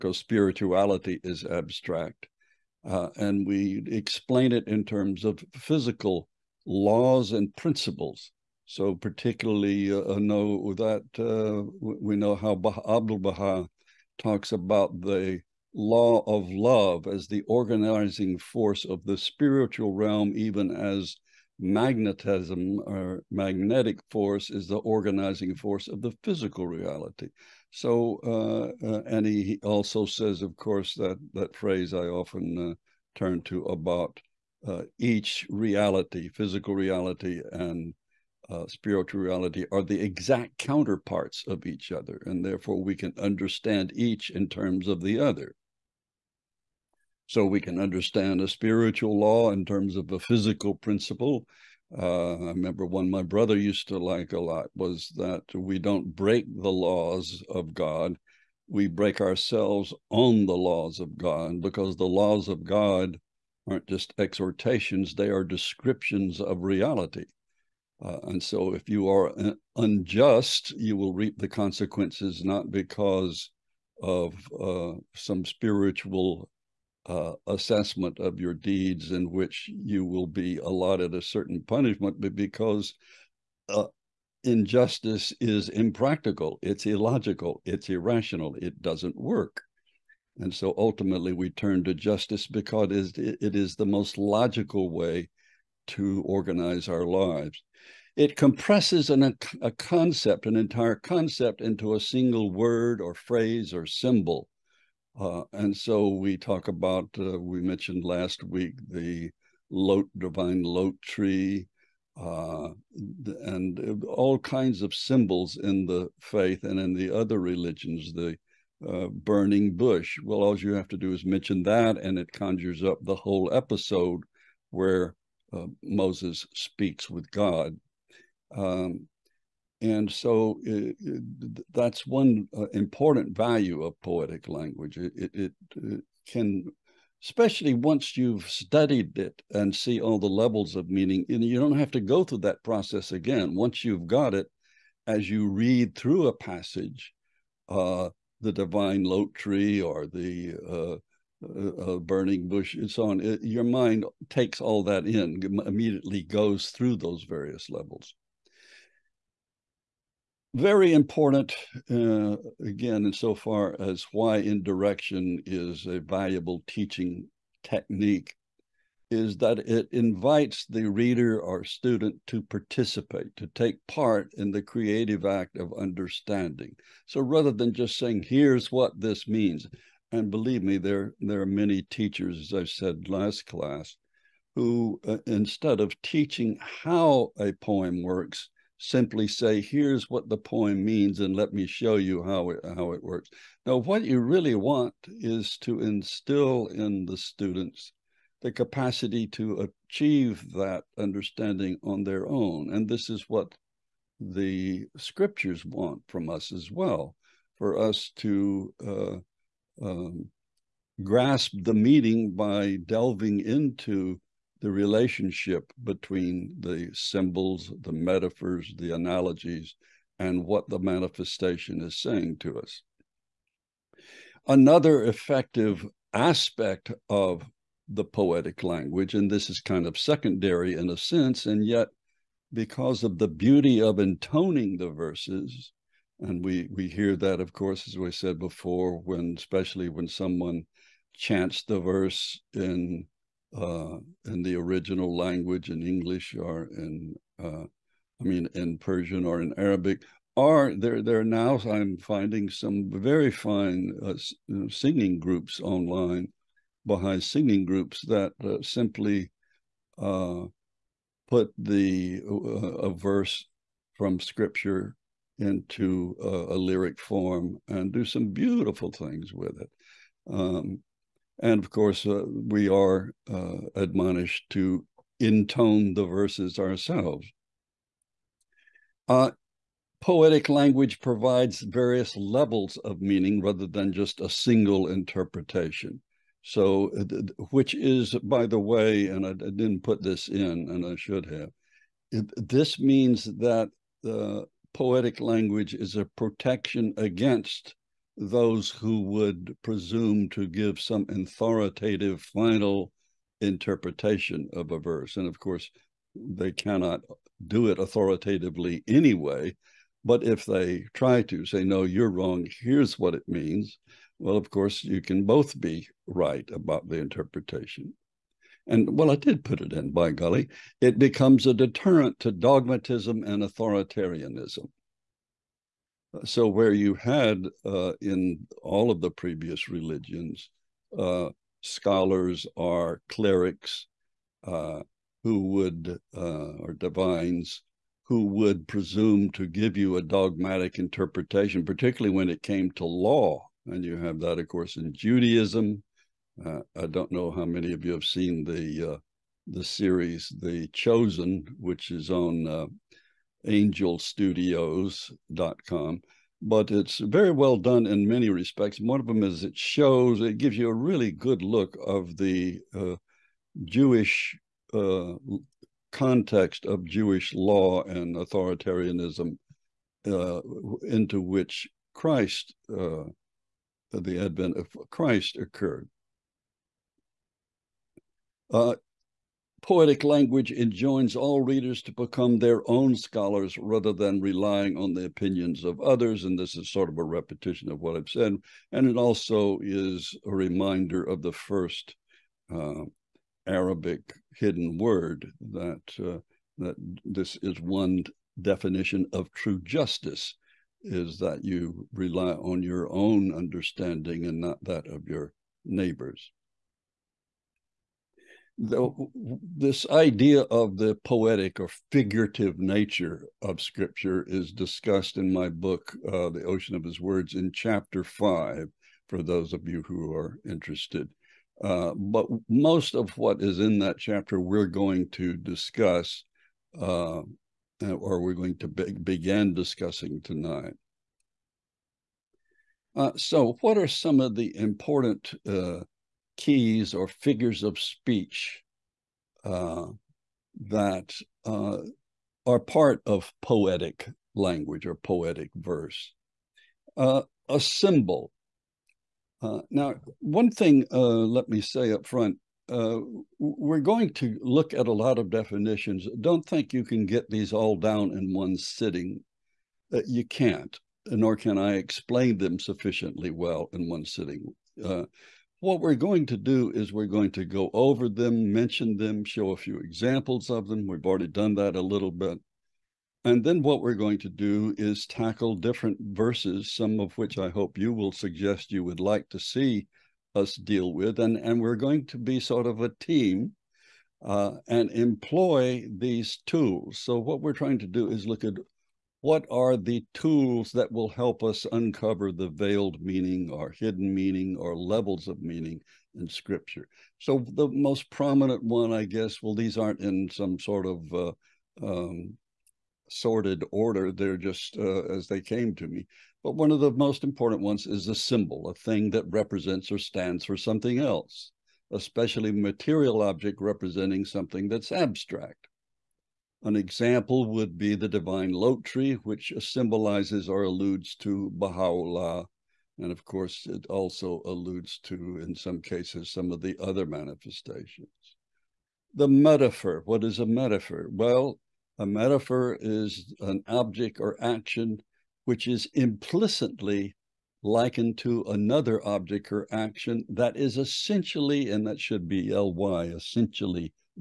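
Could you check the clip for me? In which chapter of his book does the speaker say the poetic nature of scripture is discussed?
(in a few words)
5.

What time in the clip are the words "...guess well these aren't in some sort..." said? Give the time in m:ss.
8:19.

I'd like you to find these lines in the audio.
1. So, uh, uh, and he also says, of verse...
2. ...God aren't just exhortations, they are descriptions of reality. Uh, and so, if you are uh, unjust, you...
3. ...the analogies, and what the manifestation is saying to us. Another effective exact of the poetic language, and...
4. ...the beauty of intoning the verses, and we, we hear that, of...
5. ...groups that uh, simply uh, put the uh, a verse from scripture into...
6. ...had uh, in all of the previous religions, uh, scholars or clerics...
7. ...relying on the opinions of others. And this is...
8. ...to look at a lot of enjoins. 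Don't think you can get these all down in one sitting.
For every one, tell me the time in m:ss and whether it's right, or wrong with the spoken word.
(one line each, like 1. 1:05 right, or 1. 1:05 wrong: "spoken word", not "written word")
1. 0:27 wrong: "course", not "verse"
2. 1:02 right
3. 3:38 wrong: "aspect", not "exact"
4. 3:53 right
5. 4:17 right
6. 5:26 right
7. 6:24 right
8. 7:34 wrong: "definitions", not "enjoins".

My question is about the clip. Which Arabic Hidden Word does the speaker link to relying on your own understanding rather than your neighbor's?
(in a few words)
The first.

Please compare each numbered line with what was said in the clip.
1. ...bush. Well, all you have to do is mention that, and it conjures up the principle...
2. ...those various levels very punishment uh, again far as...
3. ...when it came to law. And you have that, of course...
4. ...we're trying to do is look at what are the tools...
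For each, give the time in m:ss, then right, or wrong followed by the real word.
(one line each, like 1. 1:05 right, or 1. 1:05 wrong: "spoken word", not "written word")
1. 1:59 wrong: "whole", not "principle"
2. 2:36 wrong: "important", not "punishment"
3. 5:42 right
4. 8:07 right.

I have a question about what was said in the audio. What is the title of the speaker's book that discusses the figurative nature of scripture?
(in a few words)
The Ocean of His Words.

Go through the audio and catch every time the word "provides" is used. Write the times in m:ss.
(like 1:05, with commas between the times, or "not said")
4:40.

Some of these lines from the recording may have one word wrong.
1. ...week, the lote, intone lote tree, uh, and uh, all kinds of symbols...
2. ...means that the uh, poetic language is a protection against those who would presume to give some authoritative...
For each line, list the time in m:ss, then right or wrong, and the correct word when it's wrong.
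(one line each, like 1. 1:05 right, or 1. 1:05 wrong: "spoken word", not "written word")
1. 1:48 wrong: "divine", not "intone"
2. 4:52 right.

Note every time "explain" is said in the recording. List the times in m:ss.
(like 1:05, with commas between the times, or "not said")
0:03, 7:41.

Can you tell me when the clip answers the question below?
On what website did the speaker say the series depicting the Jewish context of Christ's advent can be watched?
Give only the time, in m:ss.
5:53.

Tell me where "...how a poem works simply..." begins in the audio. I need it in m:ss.
3:06.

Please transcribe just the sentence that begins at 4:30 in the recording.
Um, and of course, uh, we are uh, admonished to intone the verses ourselves.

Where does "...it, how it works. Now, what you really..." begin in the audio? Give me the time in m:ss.
3:12.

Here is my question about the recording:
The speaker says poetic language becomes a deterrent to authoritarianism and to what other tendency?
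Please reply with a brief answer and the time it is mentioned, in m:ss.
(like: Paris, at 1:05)
Dogmatism, at 5:22.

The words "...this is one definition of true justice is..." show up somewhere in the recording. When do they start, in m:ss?
6:37.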